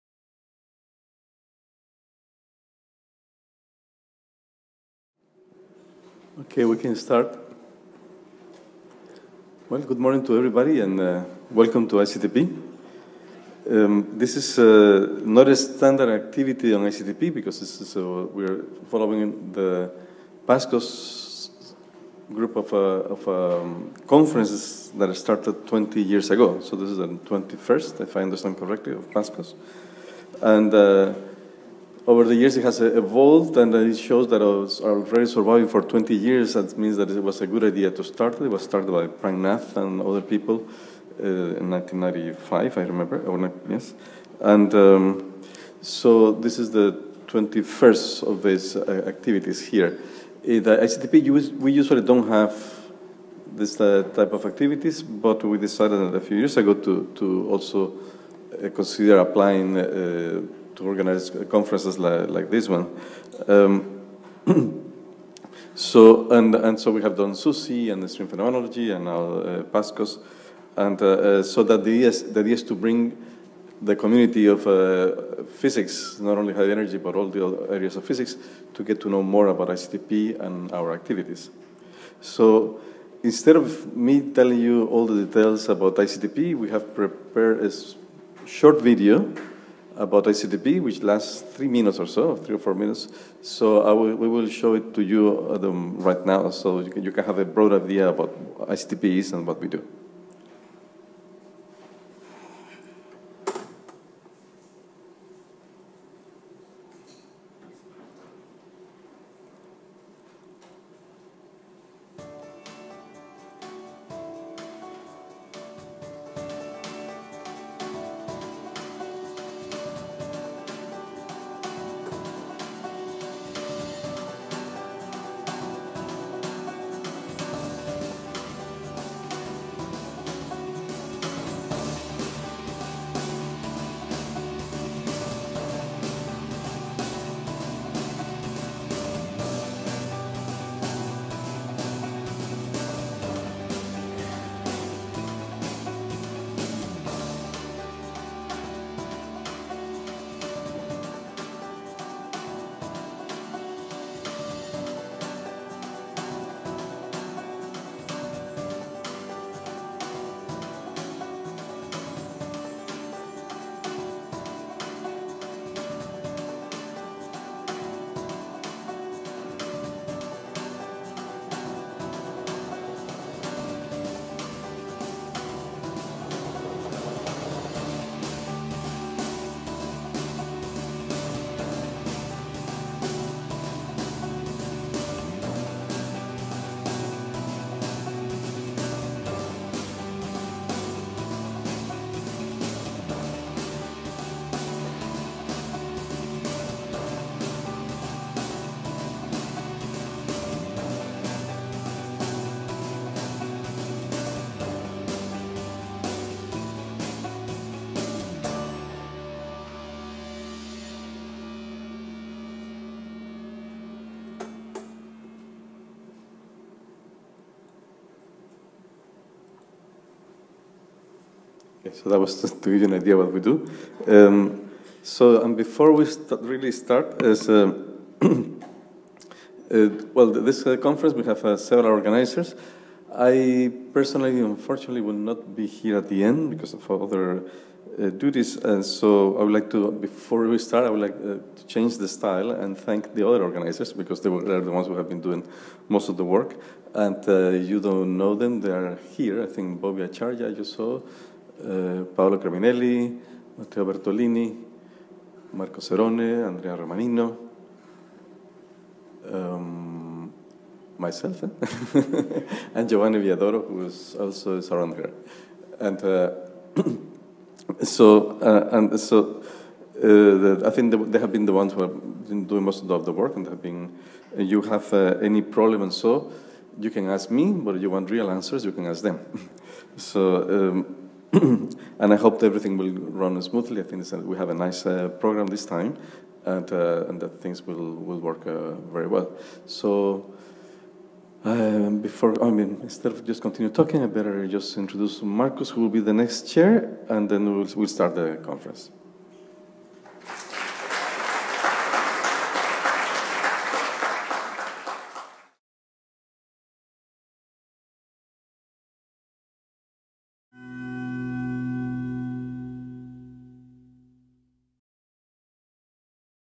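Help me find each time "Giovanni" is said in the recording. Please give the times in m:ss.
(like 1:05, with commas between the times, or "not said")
4:22.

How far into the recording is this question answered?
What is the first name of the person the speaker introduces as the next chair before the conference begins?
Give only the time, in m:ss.
4:55.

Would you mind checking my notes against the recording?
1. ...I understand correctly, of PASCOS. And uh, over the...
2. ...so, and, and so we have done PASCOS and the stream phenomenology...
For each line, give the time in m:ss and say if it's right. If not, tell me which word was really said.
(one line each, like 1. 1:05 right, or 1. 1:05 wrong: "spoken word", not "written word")
1. 0:28 right
2. 1:05 wrong: "SUSY", not "PASCOS".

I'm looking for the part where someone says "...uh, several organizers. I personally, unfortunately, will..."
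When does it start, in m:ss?
3:51.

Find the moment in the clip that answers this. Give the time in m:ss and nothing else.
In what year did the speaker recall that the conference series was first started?
0:41.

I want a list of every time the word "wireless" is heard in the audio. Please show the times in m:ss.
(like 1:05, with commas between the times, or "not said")
not said.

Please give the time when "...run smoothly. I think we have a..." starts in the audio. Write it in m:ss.
4:42.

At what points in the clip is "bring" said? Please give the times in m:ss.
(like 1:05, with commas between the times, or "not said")
1:12.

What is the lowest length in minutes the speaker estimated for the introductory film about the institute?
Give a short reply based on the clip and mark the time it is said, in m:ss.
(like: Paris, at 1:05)
3, at 1:31.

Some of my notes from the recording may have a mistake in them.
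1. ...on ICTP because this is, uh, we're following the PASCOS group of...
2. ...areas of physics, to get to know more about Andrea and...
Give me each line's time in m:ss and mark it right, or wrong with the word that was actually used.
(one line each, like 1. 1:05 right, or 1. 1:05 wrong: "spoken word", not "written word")
1. 0:16 right
2. 1:17 wrong: "ICTP", not "Andrea".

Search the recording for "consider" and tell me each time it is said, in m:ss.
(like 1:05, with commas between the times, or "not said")
0:58.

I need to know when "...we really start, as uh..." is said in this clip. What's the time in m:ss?
3:45.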